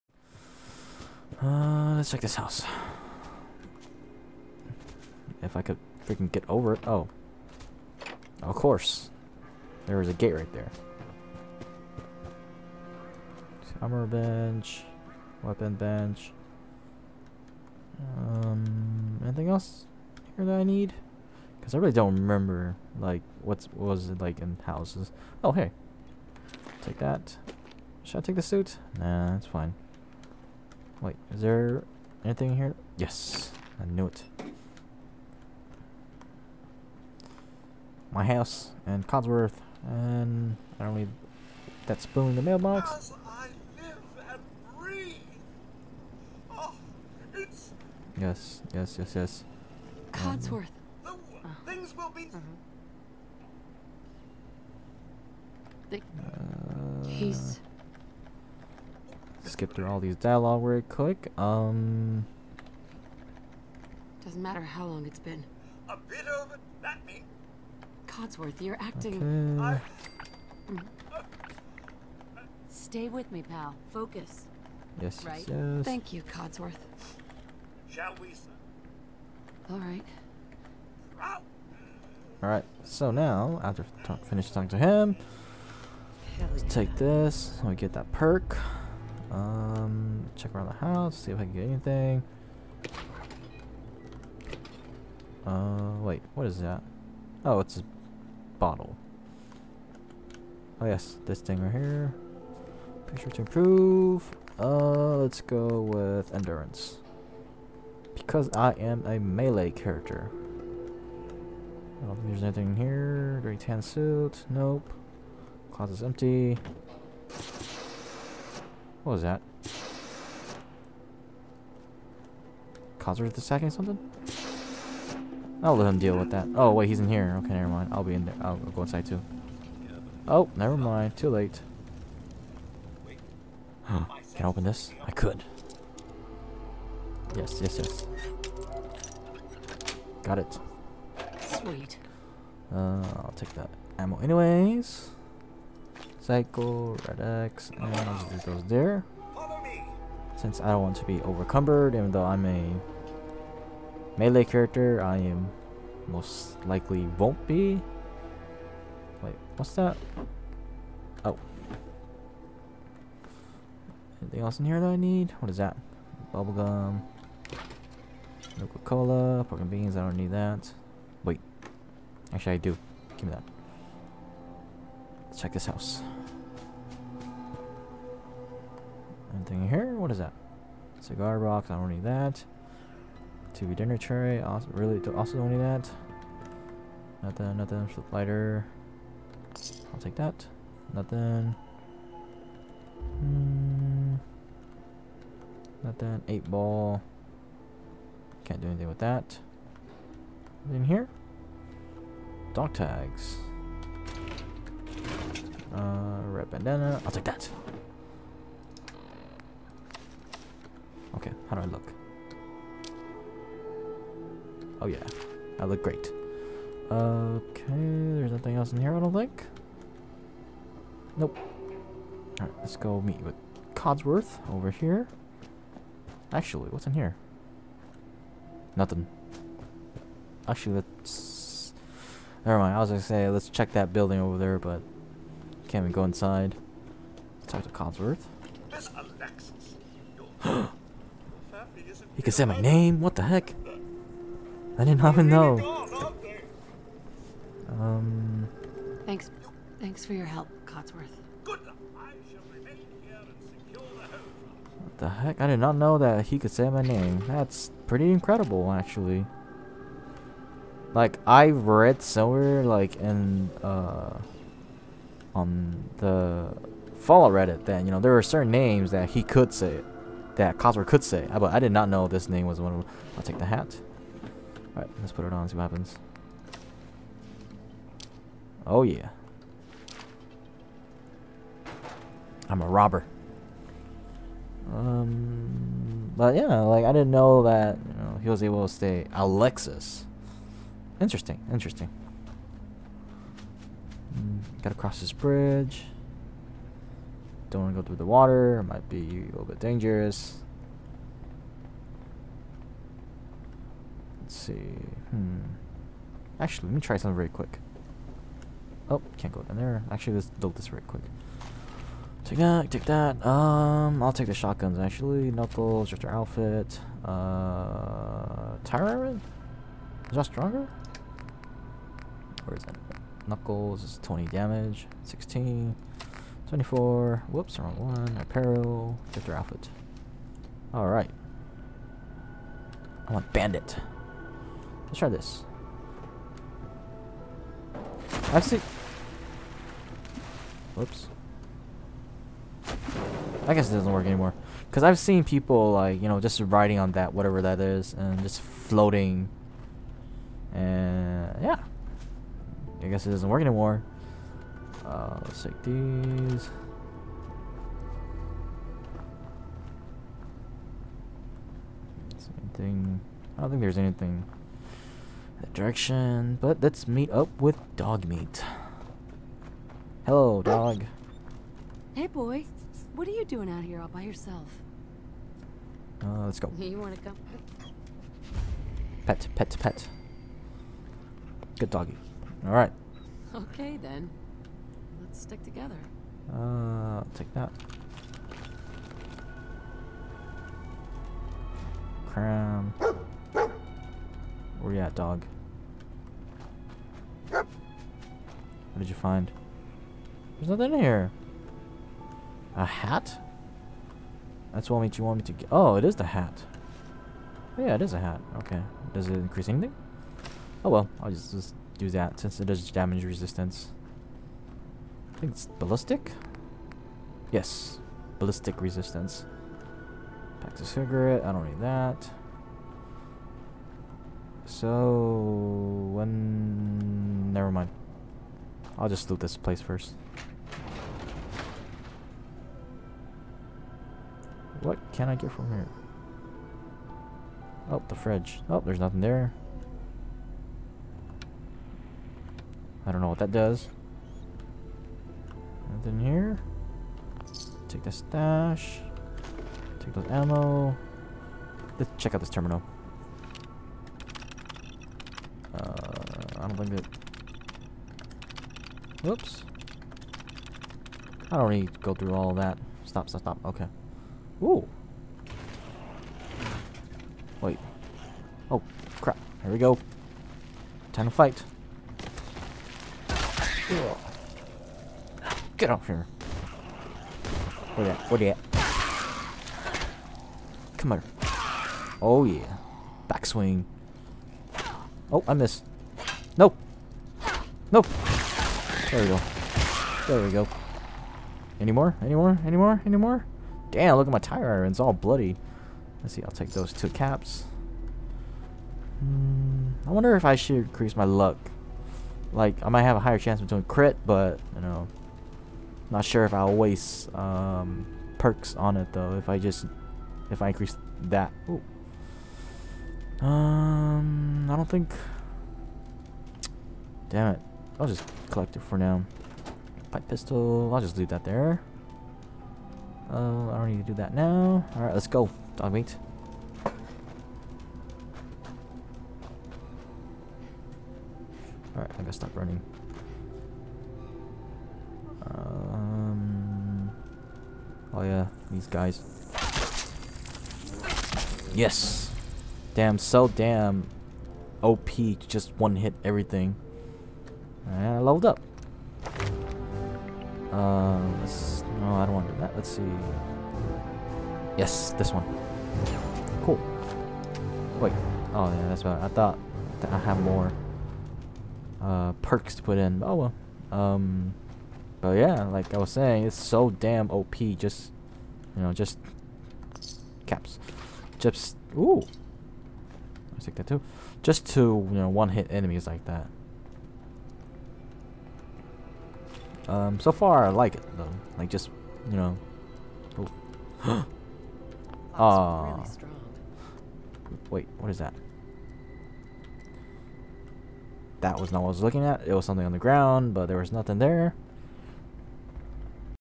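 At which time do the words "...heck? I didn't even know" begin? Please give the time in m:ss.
4:03.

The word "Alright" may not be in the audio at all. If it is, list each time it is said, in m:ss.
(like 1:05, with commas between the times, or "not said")
3:42, 4:34, 5:30, 8:44, 8:51.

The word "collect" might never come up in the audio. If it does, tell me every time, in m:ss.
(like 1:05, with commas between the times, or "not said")
8:38.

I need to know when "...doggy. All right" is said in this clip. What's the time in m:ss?
6:21.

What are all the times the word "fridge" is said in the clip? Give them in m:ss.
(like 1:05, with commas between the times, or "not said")
7:17.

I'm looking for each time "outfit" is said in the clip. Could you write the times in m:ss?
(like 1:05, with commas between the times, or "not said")
5:16, 5:29.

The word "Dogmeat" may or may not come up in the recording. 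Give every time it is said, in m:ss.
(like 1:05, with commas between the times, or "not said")
6:07, 8:45.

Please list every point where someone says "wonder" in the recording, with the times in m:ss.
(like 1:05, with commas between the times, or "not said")
8:19.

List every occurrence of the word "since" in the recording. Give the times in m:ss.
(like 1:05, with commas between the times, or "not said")
2:30, 6:52.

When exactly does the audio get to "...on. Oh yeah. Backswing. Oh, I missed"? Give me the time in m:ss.
8:00.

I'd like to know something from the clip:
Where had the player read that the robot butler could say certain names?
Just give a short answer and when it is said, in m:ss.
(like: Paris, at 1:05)
Fallout Reddit, at 4:26.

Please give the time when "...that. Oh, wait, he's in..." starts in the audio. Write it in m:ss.
2:06.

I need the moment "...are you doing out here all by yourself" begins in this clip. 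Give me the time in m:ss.
6:13.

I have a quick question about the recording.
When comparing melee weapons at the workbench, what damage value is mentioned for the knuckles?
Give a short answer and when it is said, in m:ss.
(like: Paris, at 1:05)
20, at 5:24.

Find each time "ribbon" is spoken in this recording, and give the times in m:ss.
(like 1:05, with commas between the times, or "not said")
not said.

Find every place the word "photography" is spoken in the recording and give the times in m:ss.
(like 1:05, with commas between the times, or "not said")
not said.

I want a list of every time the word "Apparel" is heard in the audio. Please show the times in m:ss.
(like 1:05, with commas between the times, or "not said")
5:28.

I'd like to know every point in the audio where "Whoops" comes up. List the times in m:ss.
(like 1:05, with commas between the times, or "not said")
5:27, 5:40, 7:39.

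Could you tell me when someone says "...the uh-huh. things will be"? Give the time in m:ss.
0:51.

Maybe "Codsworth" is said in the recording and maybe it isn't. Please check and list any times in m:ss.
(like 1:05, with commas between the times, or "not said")
0:39, 0:50, 1:08, 1:16, 3:43, 3:57, 4:10, 4:30.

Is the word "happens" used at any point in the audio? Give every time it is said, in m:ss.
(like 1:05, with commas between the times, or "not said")
4:35.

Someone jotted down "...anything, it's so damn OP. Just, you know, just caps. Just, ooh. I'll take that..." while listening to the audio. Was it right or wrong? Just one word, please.
wrong.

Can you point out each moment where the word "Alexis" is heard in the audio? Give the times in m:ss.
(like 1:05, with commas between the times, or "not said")
3:58, 4:49.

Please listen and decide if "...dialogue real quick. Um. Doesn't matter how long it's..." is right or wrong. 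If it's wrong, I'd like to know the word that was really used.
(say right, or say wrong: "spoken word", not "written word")
right.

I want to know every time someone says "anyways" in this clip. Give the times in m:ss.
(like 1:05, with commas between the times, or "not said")
2:24.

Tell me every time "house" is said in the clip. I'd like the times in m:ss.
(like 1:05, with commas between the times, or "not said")
0:02, 0:24, 0:38, 1:30, 2:55.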